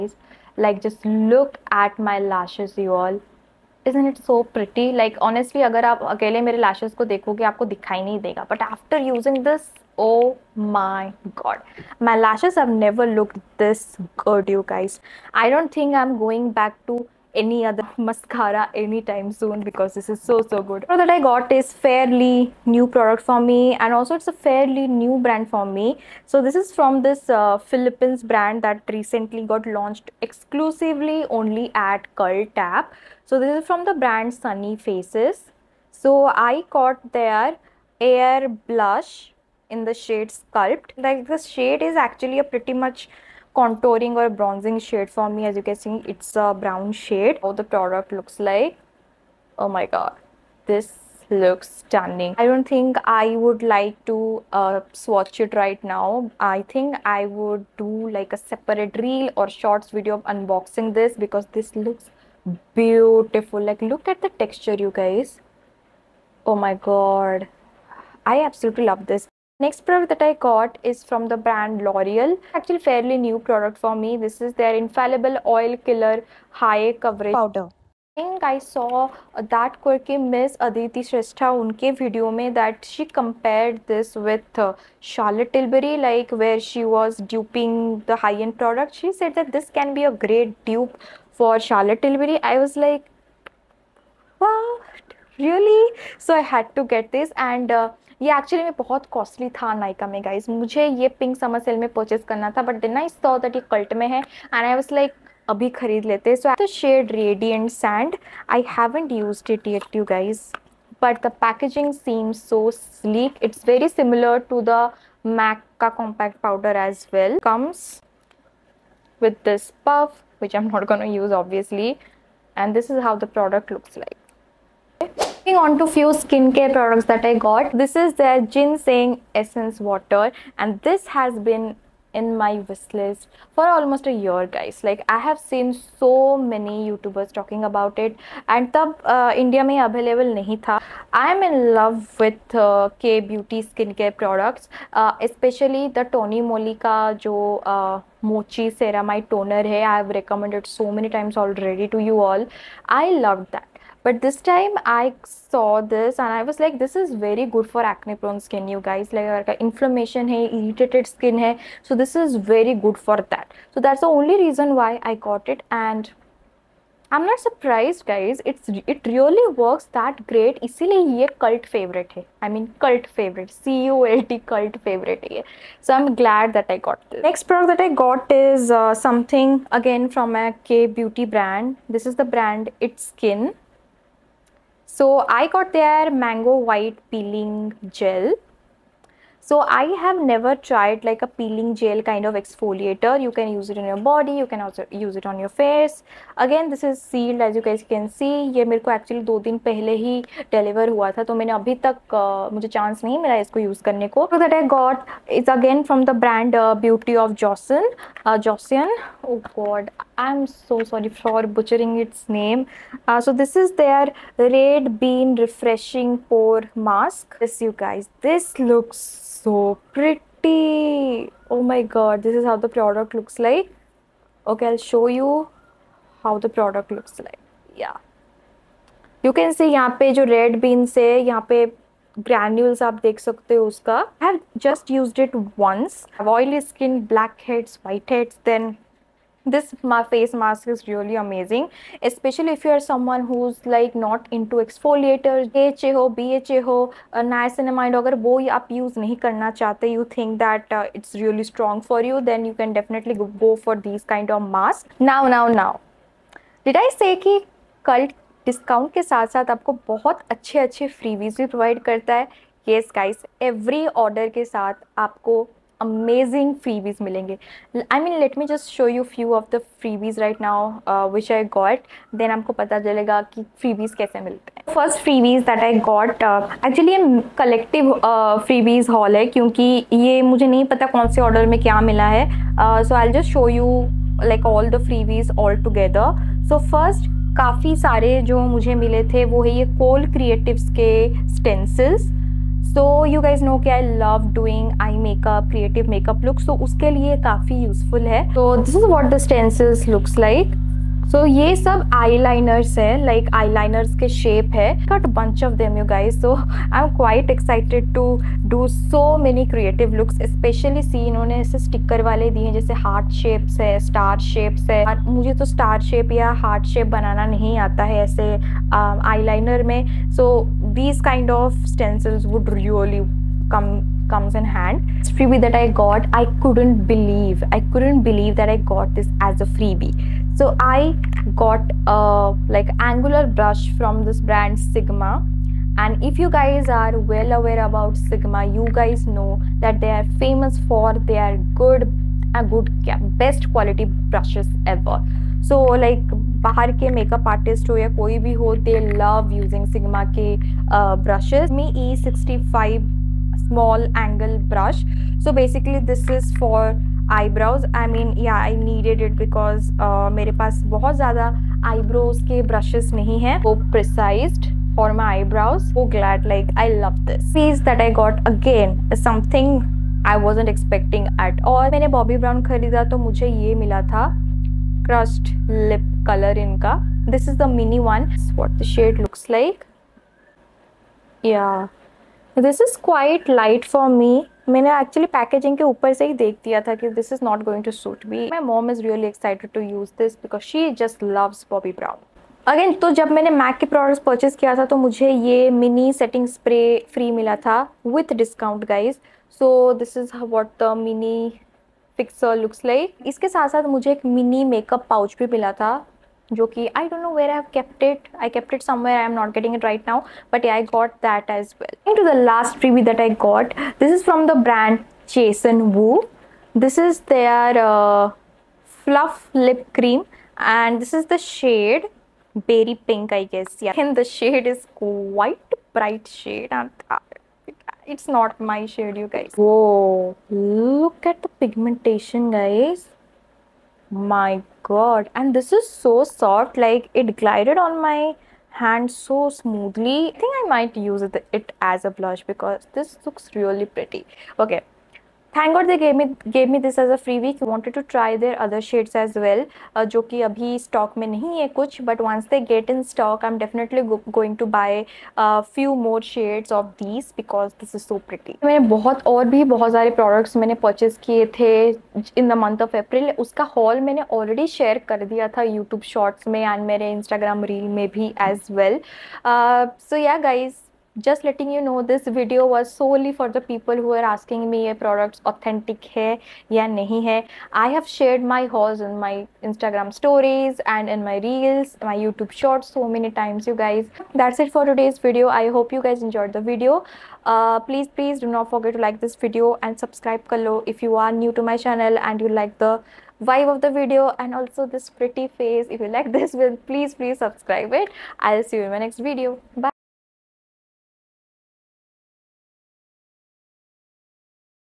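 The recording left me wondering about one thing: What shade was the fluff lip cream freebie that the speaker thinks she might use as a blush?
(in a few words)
berry pink.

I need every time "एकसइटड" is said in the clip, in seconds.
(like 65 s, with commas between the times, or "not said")
307 s, 389 s.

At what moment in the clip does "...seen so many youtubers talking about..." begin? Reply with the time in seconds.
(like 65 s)
135 s.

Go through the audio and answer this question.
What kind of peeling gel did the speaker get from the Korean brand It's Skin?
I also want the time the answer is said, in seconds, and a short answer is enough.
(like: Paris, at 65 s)
mango white peeling gel, at 186 s.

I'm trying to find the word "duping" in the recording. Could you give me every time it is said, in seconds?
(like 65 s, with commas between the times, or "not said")
87 s.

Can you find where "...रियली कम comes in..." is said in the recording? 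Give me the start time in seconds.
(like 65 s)
322 s.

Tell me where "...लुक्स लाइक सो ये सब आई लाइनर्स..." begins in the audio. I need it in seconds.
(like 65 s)
299 s.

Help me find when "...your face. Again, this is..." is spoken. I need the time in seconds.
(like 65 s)
195 s.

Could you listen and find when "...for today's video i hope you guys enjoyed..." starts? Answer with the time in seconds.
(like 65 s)
484 s.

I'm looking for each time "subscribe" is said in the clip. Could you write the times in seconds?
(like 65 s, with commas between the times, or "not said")
489 s, 497 s.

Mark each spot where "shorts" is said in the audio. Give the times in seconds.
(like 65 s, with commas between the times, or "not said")
59 s, 482 s.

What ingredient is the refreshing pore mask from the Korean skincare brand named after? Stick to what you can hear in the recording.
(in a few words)
red bean.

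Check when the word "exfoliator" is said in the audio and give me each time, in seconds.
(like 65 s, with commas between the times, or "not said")
192 s, 244 s.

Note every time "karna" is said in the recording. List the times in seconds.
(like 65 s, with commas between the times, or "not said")
249 s.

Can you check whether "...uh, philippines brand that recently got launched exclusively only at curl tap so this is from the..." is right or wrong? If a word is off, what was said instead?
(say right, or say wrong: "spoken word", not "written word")
right.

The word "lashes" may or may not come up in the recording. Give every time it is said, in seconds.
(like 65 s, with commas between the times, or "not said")
2 s, 12 s.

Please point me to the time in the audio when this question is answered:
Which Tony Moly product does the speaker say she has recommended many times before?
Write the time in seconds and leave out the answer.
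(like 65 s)
148 s.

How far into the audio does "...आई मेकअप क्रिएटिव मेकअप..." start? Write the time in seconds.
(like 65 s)
294 s.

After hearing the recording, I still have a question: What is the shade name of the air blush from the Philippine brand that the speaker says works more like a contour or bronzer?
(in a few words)
Sculpt.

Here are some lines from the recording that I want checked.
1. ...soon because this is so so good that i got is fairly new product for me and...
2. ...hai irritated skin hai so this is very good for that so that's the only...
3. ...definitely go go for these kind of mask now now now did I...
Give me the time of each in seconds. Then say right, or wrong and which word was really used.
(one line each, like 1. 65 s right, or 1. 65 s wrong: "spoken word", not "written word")
1. 19 s right
2. 160 s right
3. 252 s right.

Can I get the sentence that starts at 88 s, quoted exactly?
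She said that this can be a great dupe for Charlotte Tilbury.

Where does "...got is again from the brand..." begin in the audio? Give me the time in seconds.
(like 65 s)
204 s.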